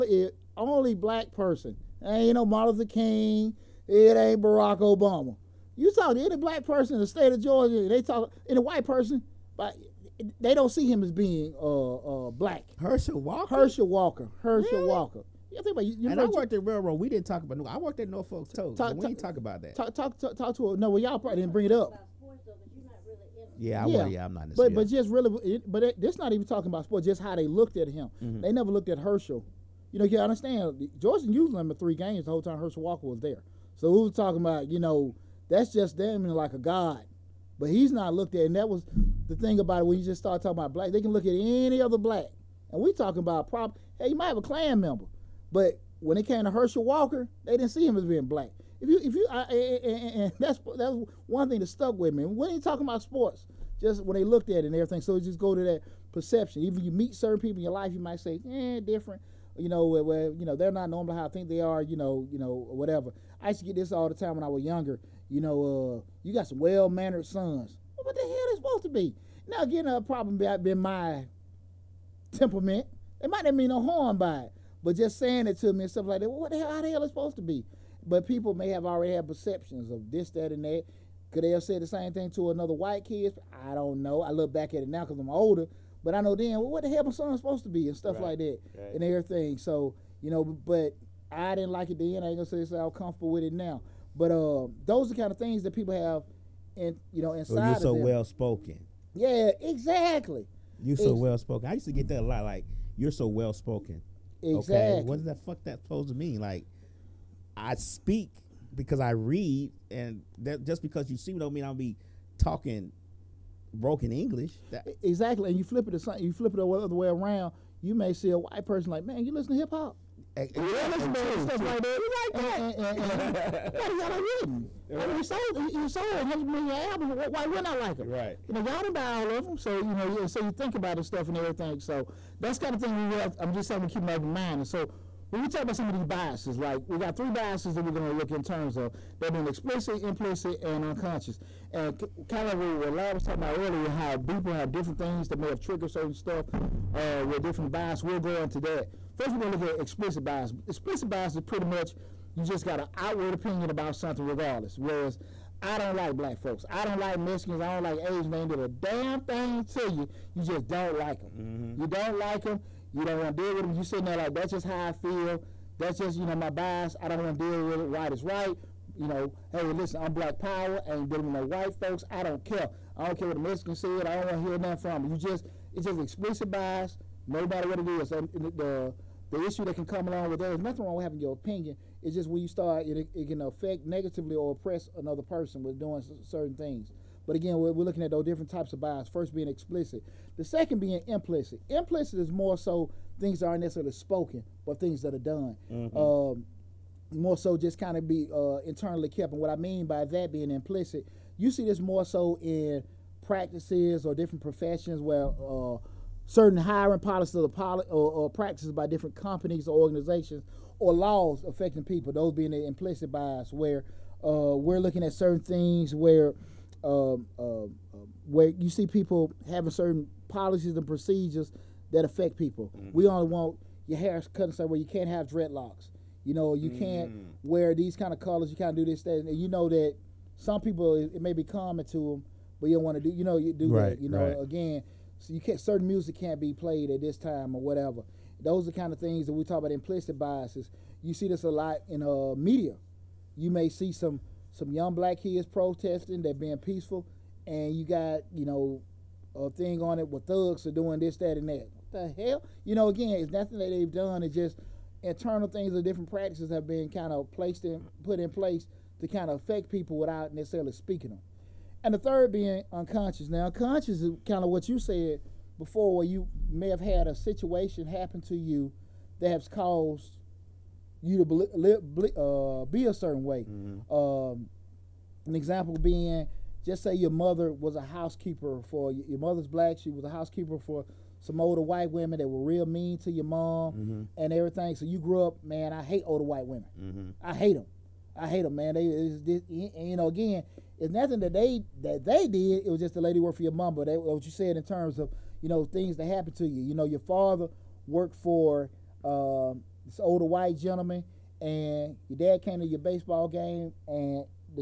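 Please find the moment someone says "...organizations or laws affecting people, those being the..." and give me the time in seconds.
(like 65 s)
209 s.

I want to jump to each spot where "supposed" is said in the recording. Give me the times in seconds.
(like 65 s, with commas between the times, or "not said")
68 s, 77 s, 87 s, 105 s.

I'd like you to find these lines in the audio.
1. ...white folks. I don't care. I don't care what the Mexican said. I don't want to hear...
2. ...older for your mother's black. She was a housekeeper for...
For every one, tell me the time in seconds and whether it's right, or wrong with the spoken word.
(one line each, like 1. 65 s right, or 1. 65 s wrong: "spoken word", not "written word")
1. 171 s right
2. 277 s wrong: "housekeeper", not "older".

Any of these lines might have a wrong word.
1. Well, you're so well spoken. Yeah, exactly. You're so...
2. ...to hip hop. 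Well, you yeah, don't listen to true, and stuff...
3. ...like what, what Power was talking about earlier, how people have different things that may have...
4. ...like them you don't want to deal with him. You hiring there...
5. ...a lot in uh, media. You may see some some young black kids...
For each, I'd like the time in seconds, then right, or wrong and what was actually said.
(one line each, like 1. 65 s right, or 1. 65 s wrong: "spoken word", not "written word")
1. 97 s right
2. 119 s right
3. 142 s wrong: "Lab", not "Power"
4. 162 s wrong: "sitting", not "hiring"
5. 241 s right.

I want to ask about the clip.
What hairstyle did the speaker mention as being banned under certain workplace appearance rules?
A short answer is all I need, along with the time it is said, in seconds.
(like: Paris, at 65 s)
Dreadlocks, at 225 s.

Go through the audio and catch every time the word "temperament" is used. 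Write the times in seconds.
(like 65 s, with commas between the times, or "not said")
72 s.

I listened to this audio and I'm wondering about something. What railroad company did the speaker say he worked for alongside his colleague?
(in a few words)
Norfolk.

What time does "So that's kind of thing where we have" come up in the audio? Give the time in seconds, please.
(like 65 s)
131 s.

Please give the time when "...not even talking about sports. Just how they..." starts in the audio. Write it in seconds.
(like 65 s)
26 s.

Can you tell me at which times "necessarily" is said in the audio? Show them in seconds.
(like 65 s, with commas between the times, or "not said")
193 s, 260 s.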